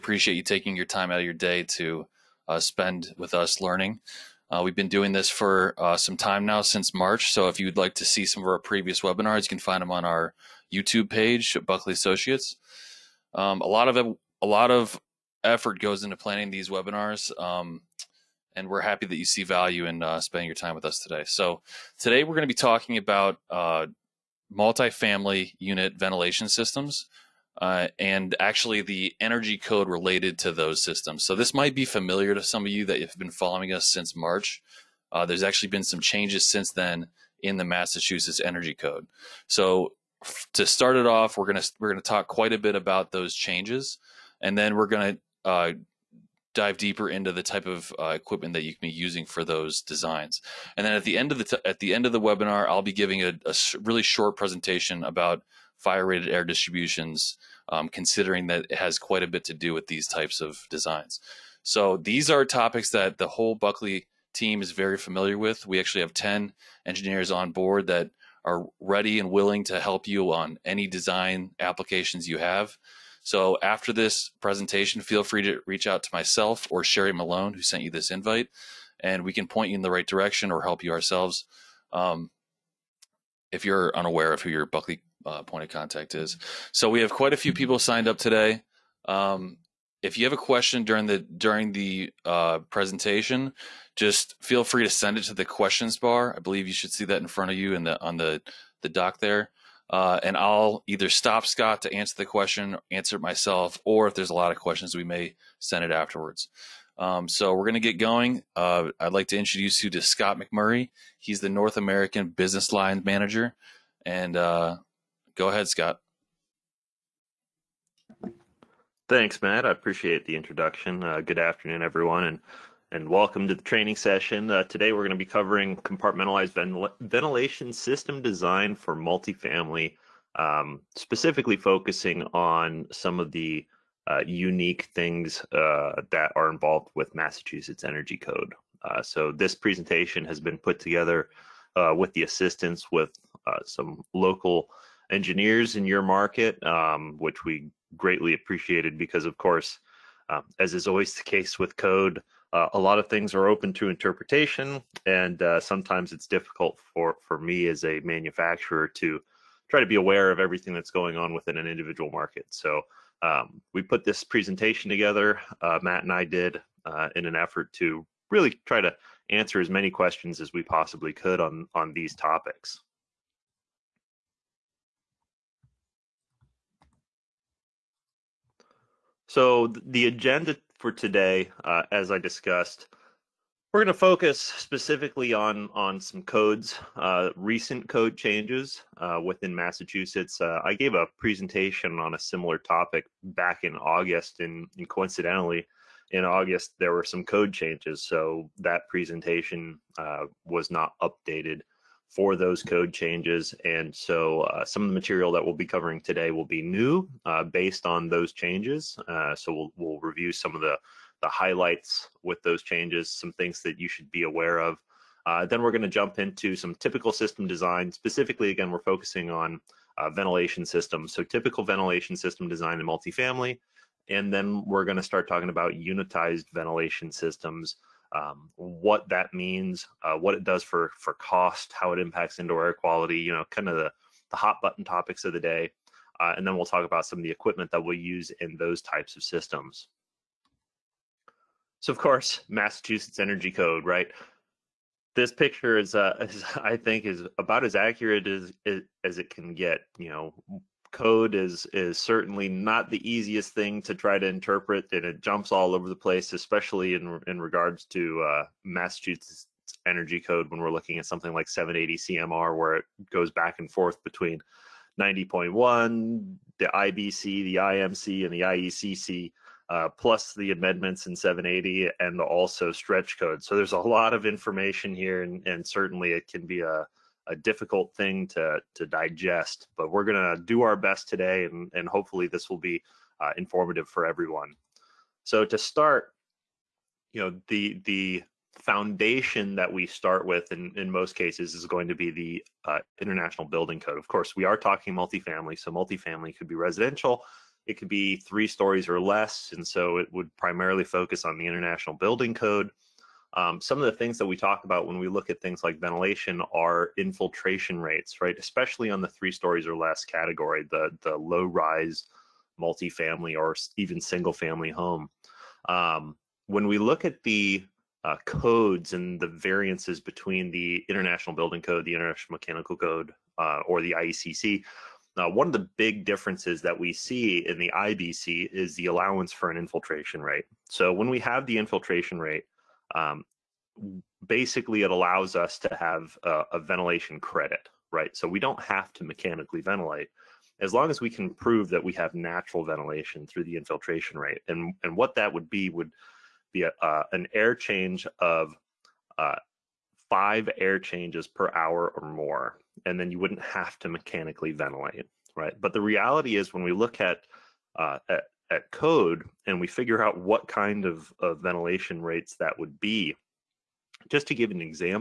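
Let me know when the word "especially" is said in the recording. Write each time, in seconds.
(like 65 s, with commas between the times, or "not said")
256 s, 308 s.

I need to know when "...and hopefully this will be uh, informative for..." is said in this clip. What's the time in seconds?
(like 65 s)
281 s.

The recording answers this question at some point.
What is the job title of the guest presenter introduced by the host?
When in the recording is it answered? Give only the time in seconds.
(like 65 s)
111 s.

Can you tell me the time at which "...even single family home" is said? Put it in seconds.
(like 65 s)
313 s.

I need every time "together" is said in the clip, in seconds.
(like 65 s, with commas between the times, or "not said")
140 s, 164 s.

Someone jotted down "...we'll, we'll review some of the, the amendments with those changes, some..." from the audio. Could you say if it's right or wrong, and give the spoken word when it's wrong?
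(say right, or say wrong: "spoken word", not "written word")
wrong: "highlights", not "amendments".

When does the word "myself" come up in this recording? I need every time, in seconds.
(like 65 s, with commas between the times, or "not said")
76 s, 103 s.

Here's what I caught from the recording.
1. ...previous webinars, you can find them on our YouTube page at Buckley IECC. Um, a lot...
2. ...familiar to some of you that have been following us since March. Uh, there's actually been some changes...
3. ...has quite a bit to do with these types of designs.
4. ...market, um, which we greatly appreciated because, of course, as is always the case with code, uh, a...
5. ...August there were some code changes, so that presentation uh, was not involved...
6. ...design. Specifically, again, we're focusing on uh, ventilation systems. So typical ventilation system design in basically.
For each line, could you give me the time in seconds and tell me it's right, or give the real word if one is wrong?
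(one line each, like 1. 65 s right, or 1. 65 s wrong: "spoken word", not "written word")
1. 8 s wrong: "Associates", not "IECC"
2. 31 s right
3. 58 s right
4. 146 s right
5. 196 s wrong: "updated", not "involved"
6. 217 s wrong: "multifamily", not "basically".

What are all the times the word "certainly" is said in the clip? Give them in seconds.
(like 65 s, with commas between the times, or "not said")
251 s, 275 s.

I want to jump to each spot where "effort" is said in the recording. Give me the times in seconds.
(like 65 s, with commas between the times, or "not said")
15 s, 167 s.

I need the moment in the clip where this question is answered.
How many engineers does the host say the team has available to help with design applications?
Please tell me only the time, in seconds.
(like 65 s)
66 s.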